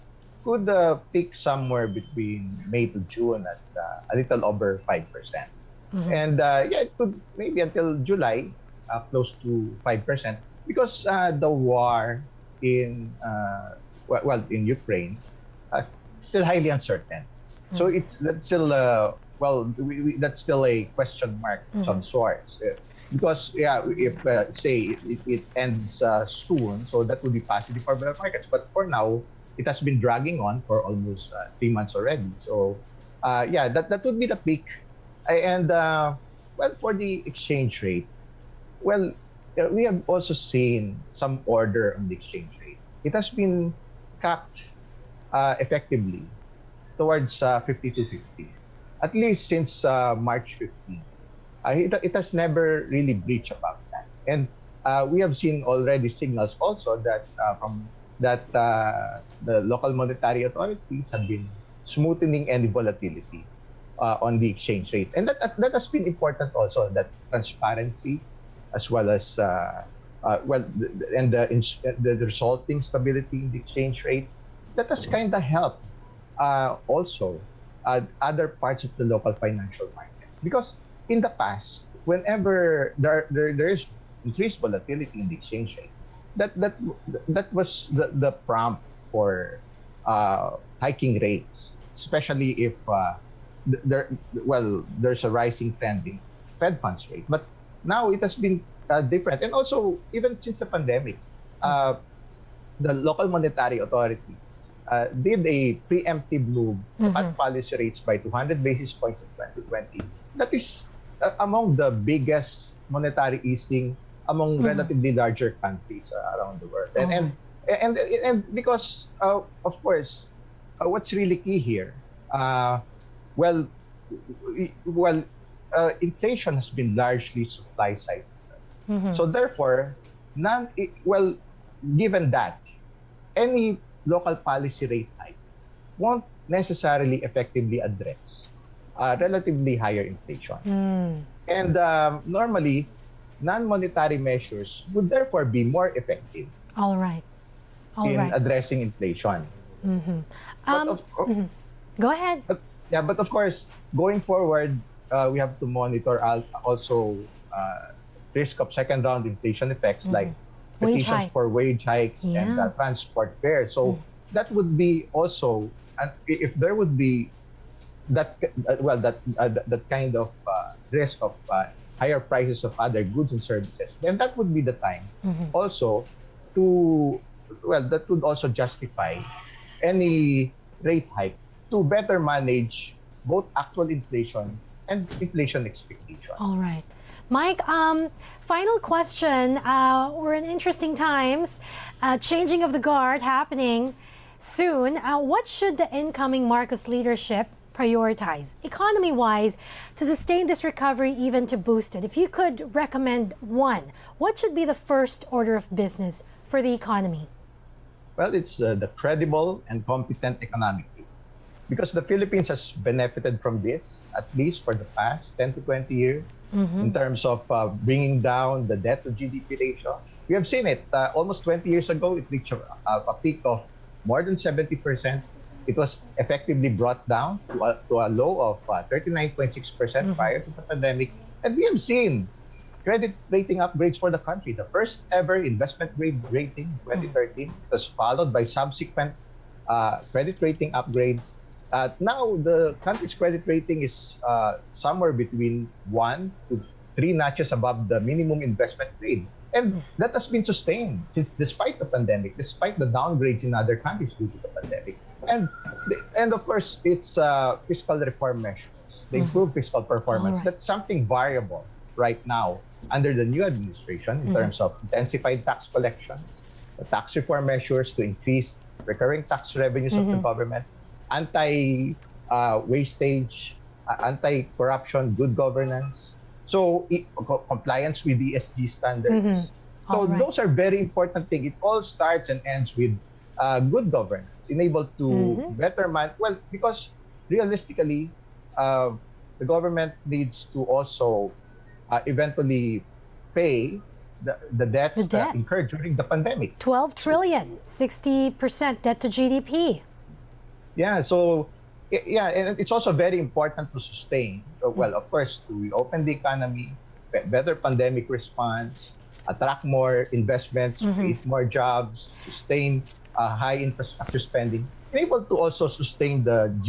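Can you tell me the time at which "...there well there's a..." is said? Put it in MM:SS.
01:33.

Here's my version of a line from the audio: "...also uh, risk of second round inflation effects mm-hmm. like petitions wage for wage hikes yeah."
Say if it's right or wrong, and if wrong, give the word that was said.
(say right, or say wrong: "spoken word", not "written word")
right.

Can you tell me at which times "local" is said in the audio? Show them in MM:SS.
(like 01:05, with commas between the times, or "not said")
00:59, 01:19, 01:42, 02:14.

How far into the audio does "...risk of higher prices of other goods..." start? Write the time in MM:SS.
02:50.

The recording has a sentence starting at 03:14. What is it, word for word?
Uh, what should the incoming Marcos leadership prioritize economy wise to sustain this recovery, even to boost it?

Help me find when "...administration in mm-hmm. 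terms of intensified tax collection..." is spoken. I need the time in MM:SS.
04:23.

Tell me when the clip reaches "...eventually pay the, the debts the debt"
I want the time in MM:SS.
04:52.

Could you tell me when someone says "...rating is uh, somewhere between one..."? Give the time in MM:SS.
04:03.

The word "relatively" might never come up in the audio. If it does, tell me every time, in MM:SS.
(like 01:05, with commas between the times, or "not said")
01:54, 02:19.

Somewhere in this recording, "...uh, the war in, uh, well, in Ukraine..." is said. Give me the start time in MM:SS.
00:11.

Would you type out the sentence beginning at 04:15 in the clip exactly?
And and of course, it's uh, fiscal reform measures.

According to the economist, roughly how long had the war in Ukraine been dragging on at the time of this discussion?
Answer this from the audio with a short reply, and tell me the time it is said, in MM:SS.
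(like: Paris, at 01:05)
3 months, at 00:31.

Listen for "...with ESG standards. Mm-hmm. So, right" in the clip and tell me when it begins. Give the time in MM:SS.
04:38.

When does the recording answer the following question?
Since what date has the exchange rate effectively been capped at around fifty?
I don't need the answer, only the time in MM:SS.
00:50.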